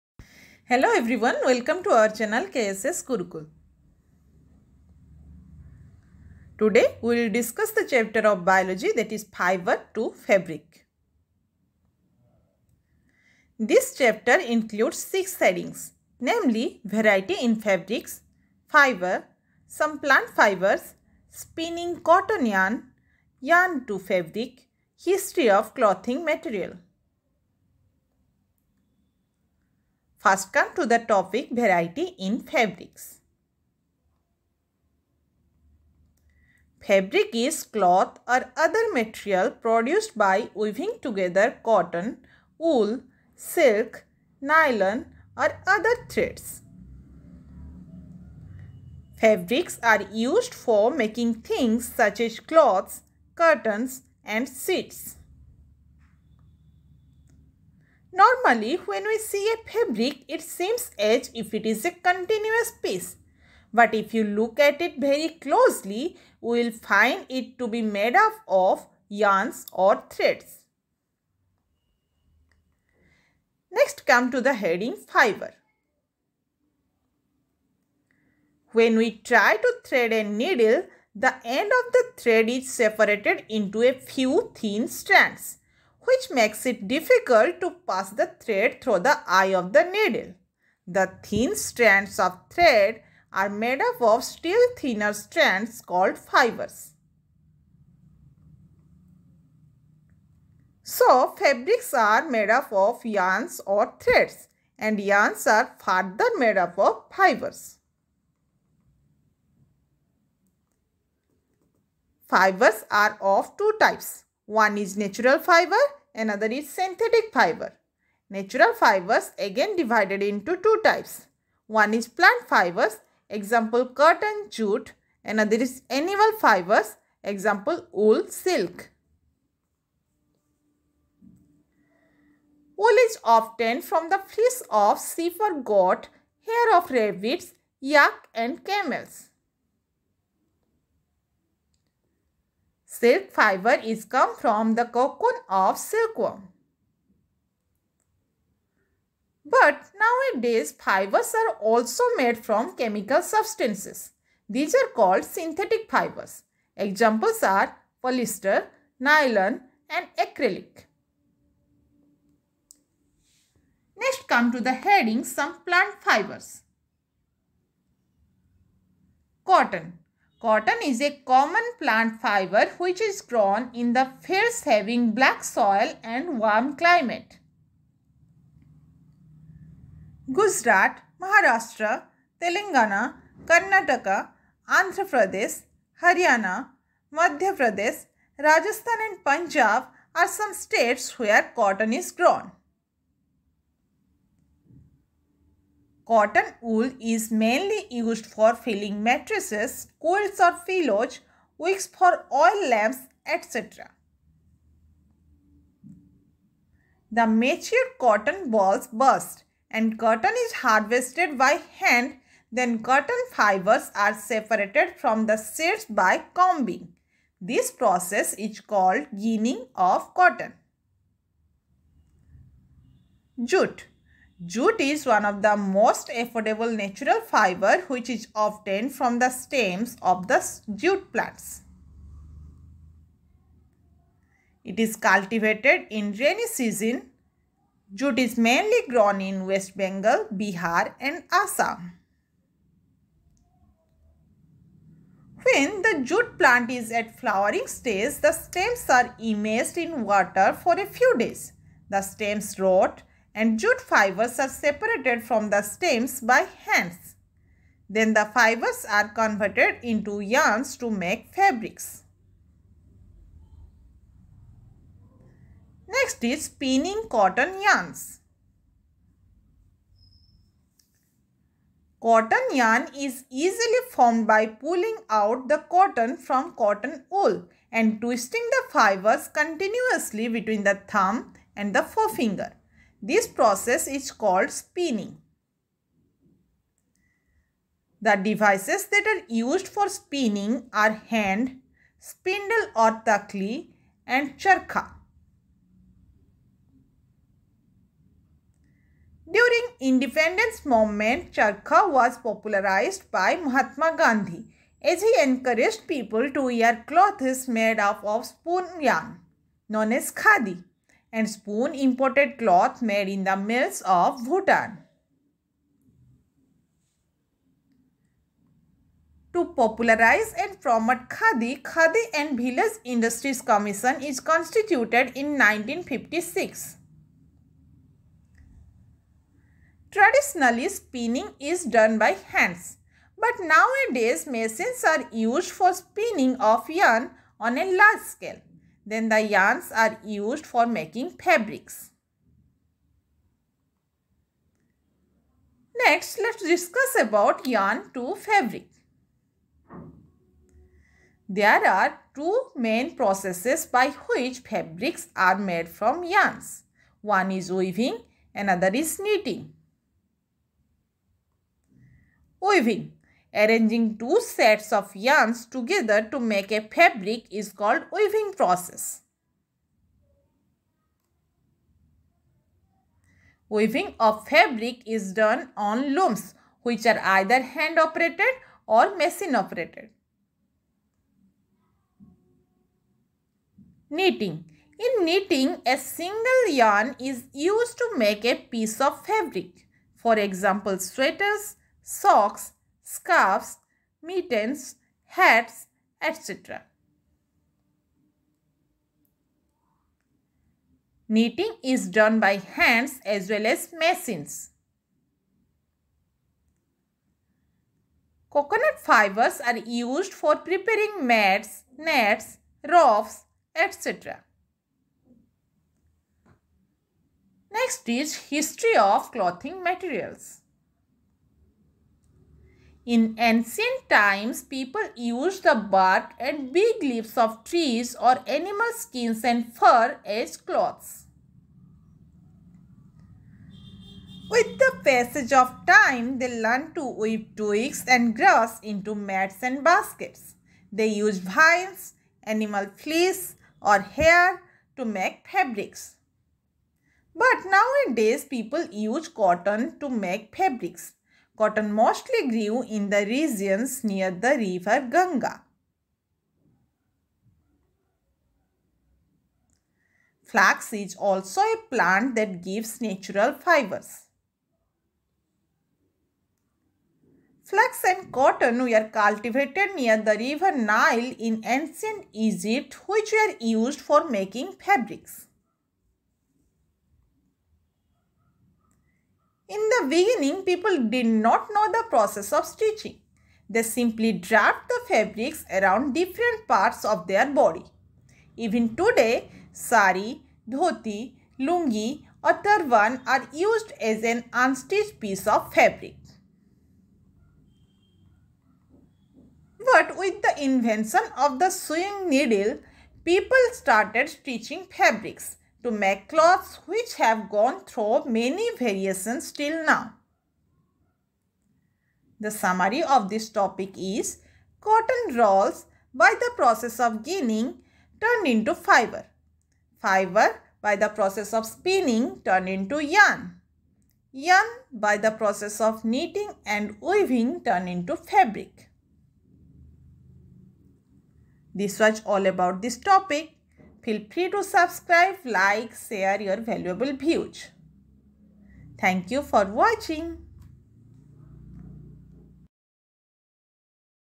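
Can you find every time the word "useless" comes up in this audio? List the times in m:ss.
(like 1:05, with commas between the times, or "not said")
not said.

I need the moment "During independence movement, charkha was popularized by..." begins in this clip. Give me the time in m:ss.
4:59.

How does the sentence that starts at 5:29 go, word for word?
Traditionally, spinning is done by hands, but nowadays machines are used for spinning of yarn on a large scale.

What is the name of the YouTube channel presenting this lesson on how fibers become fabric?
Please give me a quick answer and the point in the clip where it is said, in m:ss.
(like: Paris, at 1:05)
KSS gurukul, at 0:02.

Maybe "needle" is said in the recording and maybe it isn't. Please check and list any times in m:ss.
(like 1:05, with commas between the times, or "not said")
1:20, 1:29, 8:22.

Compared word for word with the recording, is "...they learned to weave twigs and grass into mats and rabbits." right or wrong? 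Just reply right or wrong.
wrong.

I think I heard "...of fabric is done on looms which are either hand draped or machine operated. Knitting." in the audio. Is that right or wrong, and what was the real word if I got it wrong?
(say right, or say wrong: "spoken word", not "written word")
wrong: "operated", not "draped".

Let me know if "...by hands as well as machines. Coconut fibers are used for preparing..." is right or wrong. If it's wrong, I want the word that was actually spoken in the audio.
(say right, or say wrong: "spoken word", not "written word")
right.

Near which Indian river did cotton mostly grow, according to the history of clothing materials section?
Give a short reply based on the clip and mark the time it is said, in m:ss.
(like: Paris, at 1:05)
Ganga, at 7:34.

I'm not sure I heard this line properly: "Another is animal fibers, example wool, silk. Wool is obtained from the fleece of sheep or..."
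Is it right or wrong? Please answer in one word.
right.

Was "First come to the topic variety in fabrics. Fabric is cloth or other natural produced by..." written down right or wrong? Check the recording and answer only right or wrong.
wrong.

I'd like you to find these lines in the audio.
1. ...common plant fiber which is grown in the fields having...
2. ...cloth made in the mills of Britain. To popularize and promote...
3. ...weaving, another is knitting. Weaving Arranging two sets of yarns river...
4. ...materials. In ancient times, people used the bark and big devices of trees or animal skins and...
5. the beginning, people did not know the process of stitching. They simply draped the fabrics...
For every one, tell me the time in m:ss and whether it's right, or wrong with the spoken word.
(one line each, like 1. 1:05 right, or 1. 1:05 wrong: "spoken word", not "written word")
1. 2:51 right
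2. 5:12 right
3. 5:57 wrong: "together", not "river"
4. 6:59 wrong: "leaves", not "devices"
5. 7:59 right.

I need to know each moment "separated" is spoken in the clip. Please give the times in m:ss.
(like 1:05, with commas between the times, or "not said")
1:22, 3:34, 4:14.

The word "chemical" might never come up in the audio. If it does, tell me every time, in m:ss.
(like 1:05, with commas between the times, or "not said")
2:32.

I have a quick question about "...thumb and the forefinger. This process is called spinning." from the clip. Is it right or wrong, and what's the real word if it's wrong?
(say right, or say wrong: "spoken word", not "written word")
right.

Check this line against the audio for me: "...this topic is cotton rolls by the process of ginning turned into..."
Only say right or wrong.
right.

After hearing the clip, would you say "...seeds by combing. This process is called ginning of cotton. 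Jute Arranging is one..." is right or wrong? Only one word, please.
wrong.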